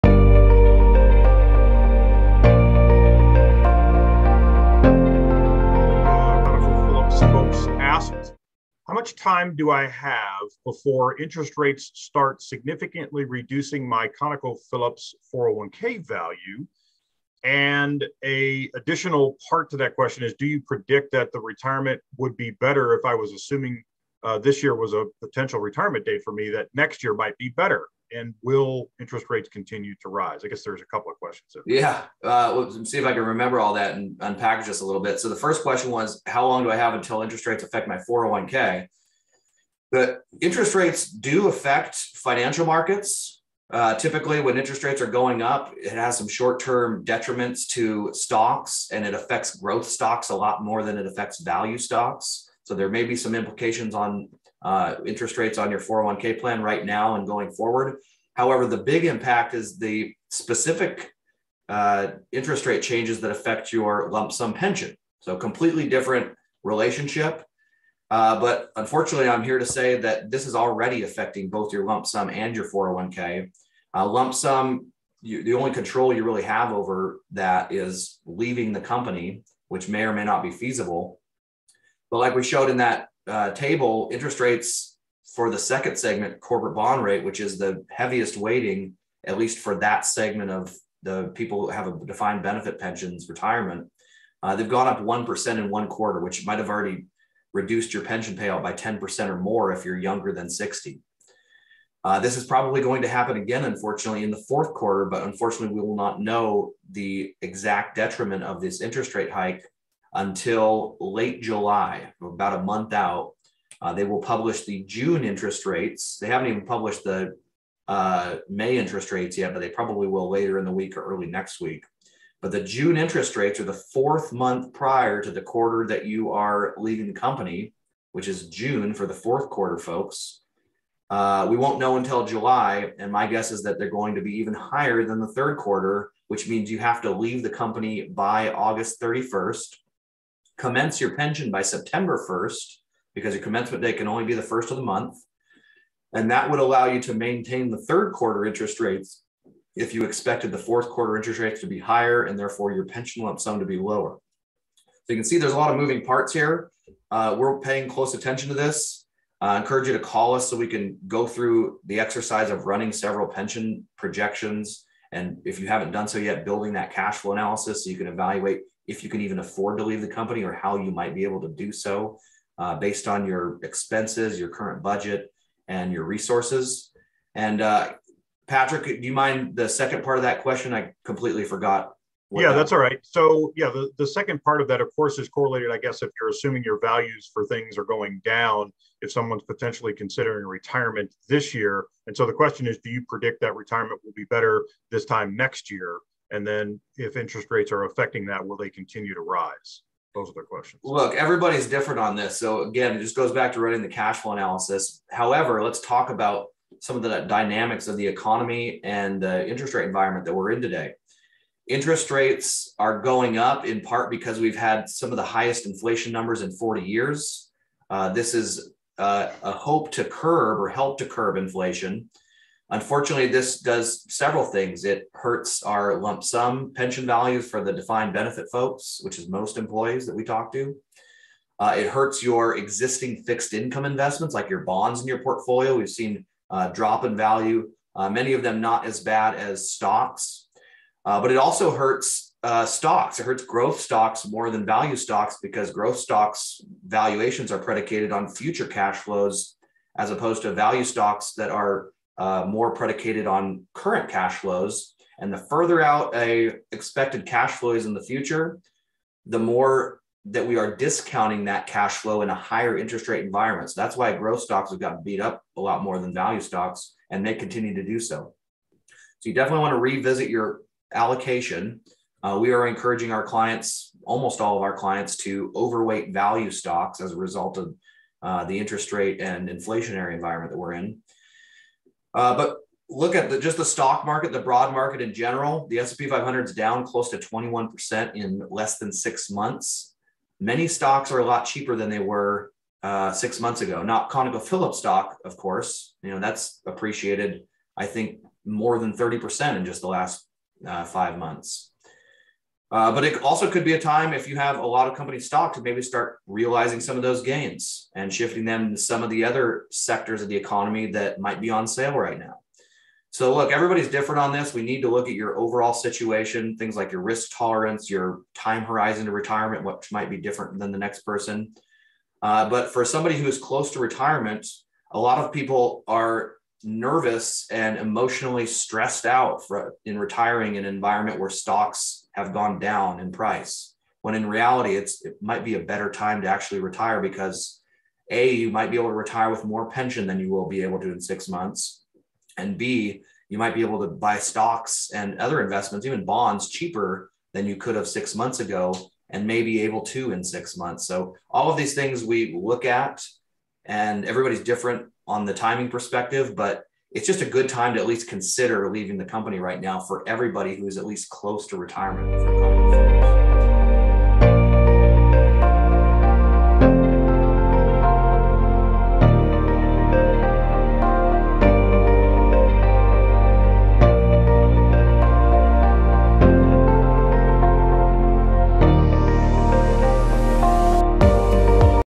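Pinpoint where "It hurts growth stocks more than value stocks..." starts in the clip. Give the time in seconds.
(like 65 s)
243 s.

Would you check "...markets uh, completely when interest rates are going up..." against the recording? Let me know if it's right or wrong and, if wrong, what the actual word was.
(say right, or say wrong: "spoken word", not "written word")
wrong: "typically", not "completely".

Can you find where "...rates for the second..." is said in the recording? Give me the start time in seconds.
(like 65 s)
84 s.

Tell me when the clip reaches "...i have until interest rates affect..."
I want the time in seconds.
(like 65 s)
36 s.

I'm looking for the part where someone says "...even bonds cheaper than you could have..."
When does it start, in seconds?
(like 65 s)
345 s.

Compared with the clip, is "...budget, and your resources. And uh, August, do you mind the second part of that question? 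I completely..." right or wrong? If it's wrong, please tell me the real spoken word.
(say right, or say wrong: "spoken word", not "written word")
wrong: "Patrick", not "August".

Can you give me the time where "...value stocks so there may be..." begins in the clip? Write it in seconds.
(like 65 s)
51 s.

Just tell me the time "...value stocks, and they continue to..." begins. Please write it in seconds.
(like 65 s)
266 s.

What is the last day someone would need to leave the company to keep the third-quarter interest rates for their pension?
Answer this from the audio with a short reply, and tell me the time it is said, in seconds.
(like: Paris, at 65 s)
August 31st, at 138 s.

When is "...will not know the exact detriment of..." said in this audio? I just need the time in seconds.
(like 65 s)
105 s.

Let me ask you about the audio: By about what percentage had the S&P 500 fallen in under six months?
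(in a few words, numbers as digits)
21%.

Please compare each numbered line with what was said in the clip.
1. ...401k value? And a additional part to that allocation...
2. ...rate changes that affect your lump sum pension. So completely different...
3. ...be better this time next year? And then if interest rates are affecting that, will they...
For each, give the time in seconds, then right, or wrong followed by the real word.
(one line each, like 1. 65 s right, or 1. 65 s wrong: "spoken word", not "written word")
1. 15 s wrong: "question", not "allocation"
2. 62 s right
3. 194 s right.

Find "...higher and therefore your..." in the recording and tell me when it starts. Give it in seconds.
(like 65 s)
151 s.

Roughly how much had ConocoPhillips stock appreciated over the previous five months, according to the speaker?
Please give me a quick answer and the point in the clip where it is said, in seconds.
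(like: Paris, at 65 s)
more than 30%, at 298 s.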